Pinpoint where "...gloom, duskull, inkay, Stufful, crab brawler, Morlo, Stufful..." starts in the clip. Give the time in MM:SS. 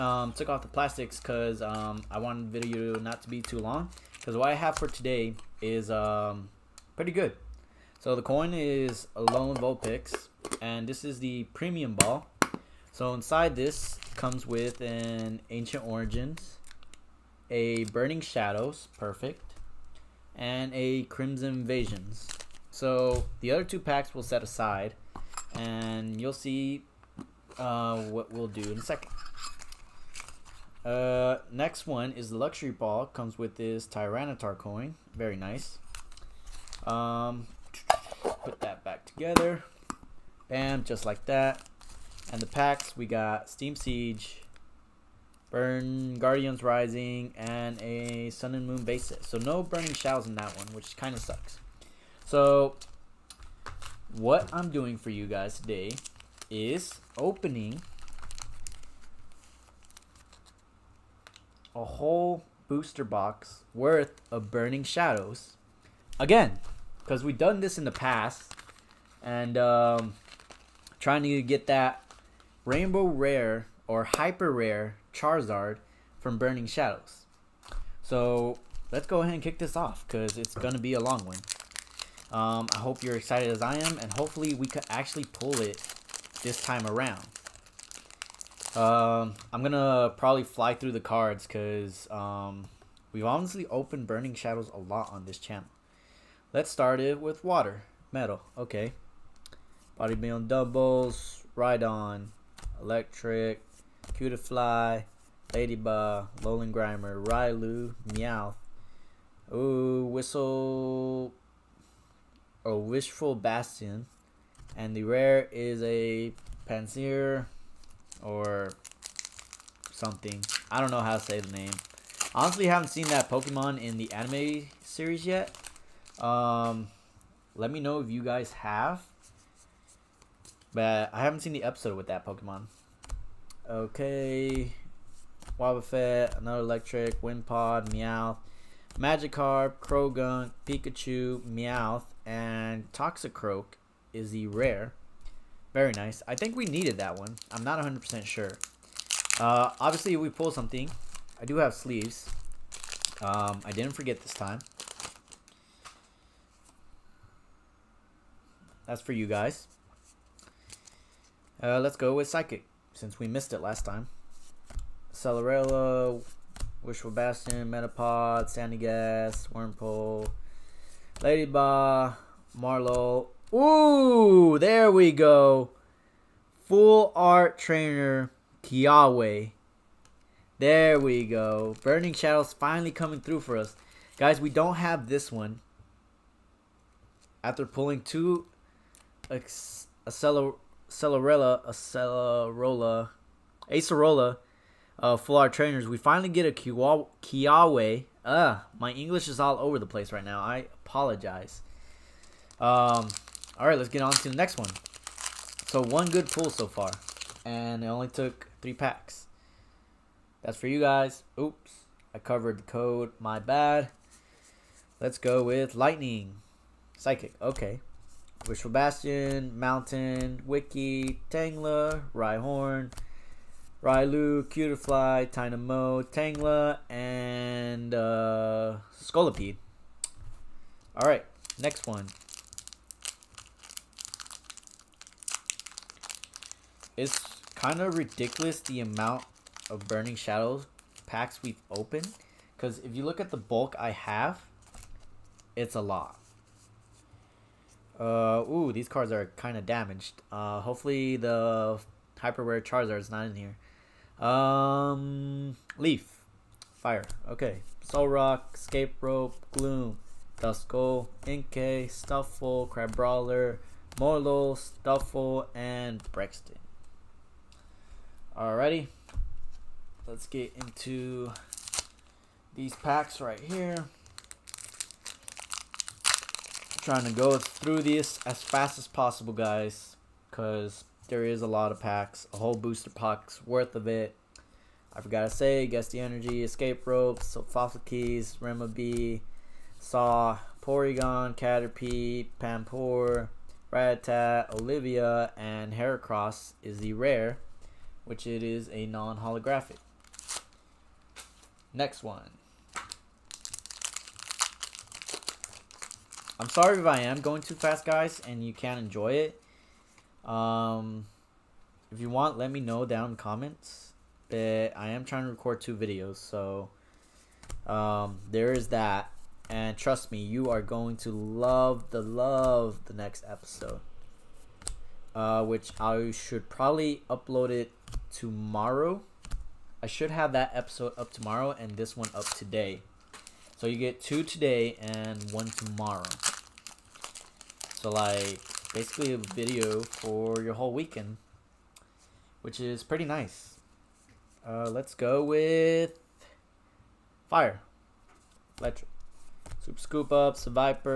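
04:19.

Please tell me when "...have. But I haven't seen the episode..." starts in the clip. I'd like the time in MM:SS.
02:08.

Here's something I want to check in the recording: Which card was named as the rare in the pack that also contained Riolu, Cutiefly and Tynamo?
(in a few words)
Scolipede.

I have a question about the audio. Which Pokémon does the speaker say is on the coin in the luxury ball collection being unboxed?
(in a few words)
Tyranitar.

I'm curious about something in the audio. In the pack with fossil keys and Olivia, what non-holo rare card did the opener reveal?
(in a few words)
Heracross.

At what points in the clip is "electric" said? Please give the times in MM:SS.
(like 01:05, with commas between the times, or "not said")
01:42, 02:16, 05:48.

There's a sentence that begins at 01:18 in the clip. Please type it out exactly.
So let's go ahead and kick this off because it's going to be a long one.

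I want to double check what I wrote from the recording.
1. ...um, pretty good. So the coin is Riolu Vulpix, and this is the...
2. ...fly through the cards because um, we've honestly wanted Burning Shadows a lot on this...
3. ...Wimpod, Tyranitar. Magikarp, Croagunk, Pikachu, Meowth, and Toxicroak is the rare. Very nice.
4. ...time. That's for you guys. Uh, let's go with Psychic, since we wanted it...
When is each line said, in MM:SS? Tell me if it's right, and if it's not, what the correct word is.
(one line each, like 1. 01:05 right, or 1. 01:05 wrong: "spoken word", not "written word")
1. 00:05 wrong: "Lone", not "Riolu"
2. 01:30 wrong: "opened", not "wanted"
3. 02:17 wrong: "Meowth", not "Tyranitar"
4. 02:34 wrong: "missed", not "wanted".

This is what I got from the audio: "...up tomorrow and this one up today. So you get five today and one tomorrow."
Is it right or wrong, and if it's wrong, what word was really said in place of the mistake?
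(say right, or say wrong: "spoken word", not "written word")
wrong: "two", not "five".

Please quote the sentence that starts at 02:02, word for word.
Honestly, haven't seen that Pokemon in the anime series yet.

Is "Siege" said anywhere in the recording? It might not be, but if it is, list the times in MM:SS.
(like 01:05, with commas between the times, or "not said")
00:43.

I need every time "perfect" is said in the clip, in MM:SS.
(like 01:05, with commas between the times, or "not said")
00:18.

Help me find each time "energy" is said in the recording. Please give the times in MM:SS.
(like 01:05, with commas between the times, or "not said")
04:45.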